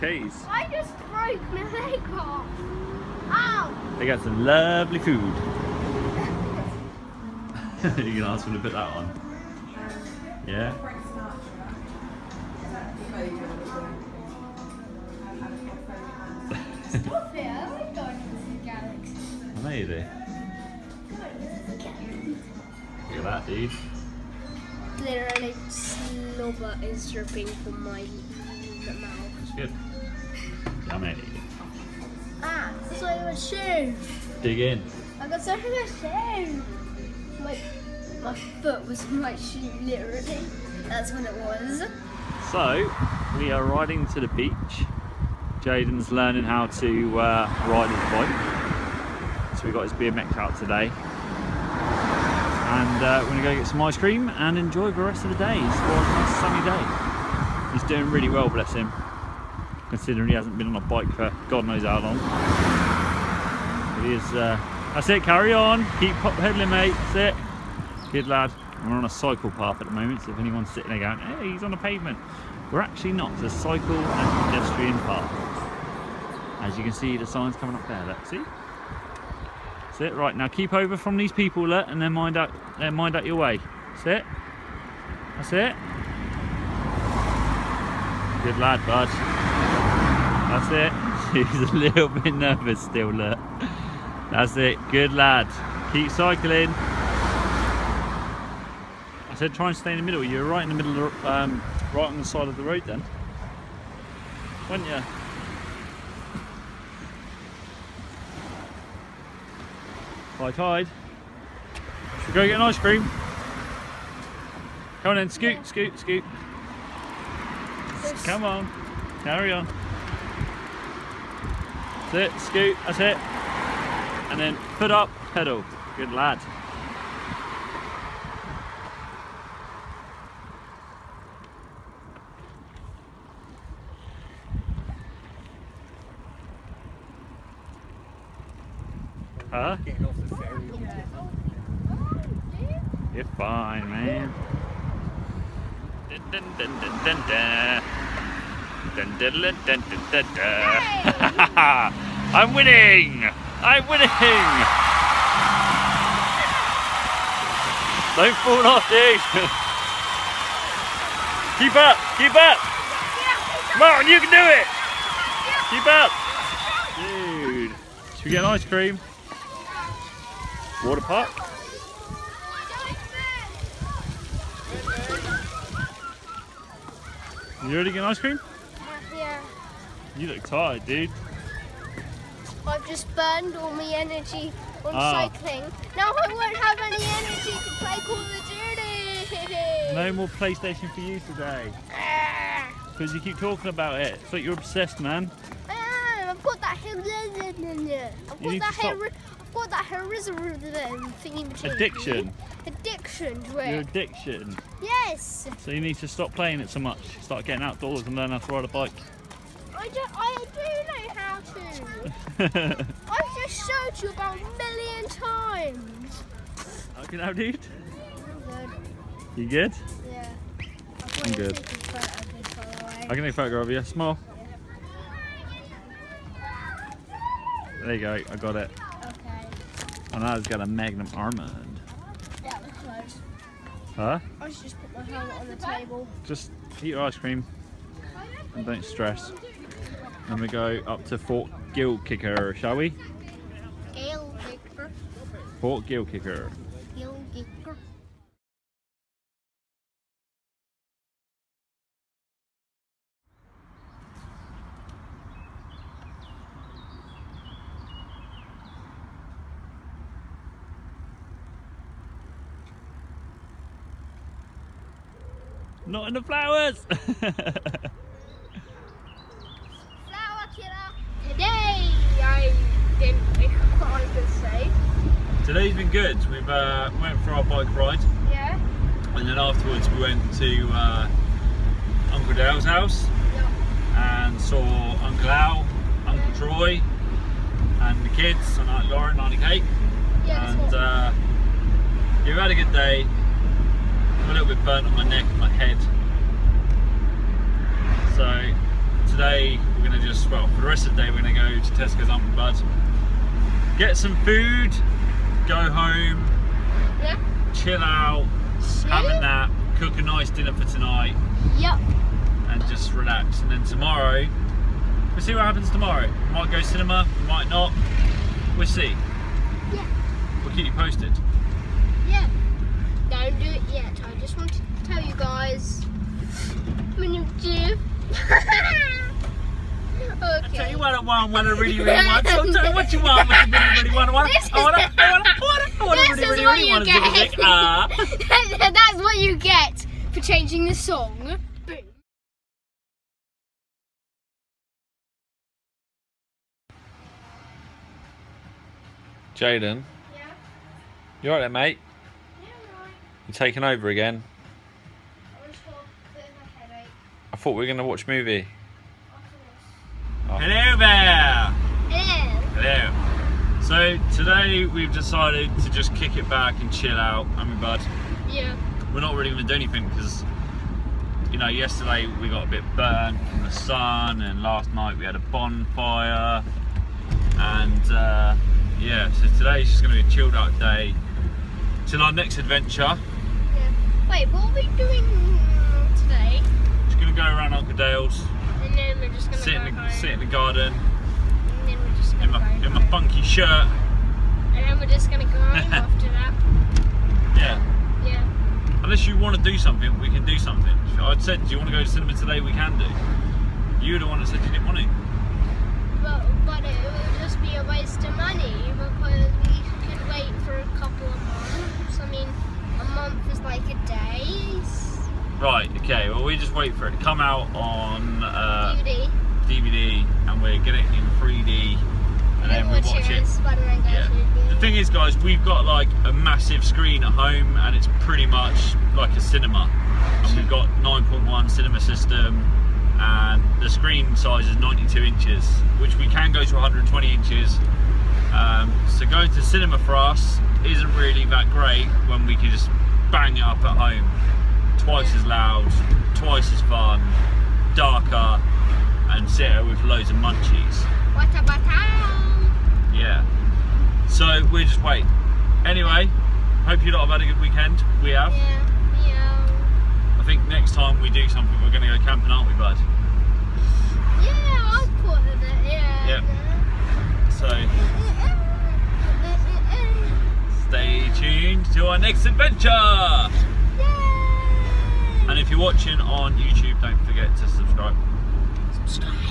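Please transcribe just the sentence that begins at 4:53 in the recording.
I'm a little bit burnt on my neck and my head.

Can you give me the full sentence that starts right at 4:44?
and saw Uncle Al, Uncle yeah.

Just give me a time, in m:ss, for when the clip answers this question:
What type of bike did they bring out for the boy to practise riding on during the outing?
0:49.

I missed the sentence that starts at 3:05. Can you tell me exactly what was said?
Now I won't have any energy to play Call of Duty.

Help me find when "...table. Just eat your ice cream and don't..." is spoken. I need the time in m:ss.
3:55.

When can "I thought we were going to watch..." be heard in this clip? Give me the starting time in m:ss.
5:57.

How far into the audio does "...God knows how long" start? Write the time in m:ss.
1:01.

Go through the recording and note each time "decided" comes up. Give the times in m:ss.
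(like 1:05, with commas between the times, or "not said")
6:04.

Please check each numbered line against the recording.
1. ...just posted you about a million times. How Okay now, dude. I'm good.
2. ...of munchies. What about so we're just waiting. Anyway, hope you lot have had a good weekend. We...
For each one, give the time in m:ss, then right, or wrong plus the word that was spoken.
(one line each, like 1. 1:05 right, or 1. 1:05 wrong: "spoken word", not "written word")
1. 3:33 wrong: "showed", not "posted"
2. 7:30 right.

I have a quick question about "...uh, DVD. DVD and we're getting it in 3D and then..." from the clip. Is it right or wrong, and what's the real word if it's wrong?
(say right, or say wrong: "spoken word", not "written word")
right.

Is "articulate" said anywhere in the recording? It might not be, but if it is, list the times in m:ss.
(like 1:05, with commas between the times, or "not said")
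not said.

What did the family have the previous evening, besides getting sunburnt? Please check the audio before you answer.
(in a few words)
A bonfire.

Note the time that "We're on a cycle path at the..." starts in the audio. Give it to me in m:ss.
1:08.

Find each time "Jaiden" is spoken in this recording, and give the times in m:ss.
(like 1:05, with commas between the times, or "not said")
0:45, 5:49.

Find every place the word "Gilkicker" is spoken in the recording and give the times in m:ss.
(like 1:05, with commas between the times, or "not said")
4:01, 4:05.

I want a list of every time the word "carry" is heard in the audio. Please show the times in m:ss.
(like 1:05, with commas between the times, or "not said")
1:05, 1:59.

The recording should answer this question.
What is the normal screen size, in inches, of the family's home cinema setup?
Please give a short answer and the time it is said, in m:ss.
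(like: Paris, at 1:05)
92 inches, at 7:14.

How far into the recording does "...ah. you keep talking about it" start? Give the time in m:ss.
3:13.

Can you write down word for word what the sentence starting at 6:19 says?
So today's just going to be a chilled out day till our next adventure.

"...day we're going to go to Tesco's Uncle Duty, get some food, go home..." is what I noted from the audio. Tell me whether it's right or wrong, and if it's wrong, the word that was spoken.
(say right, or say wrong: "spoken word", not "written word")
wrong: "Bud", not "Duty".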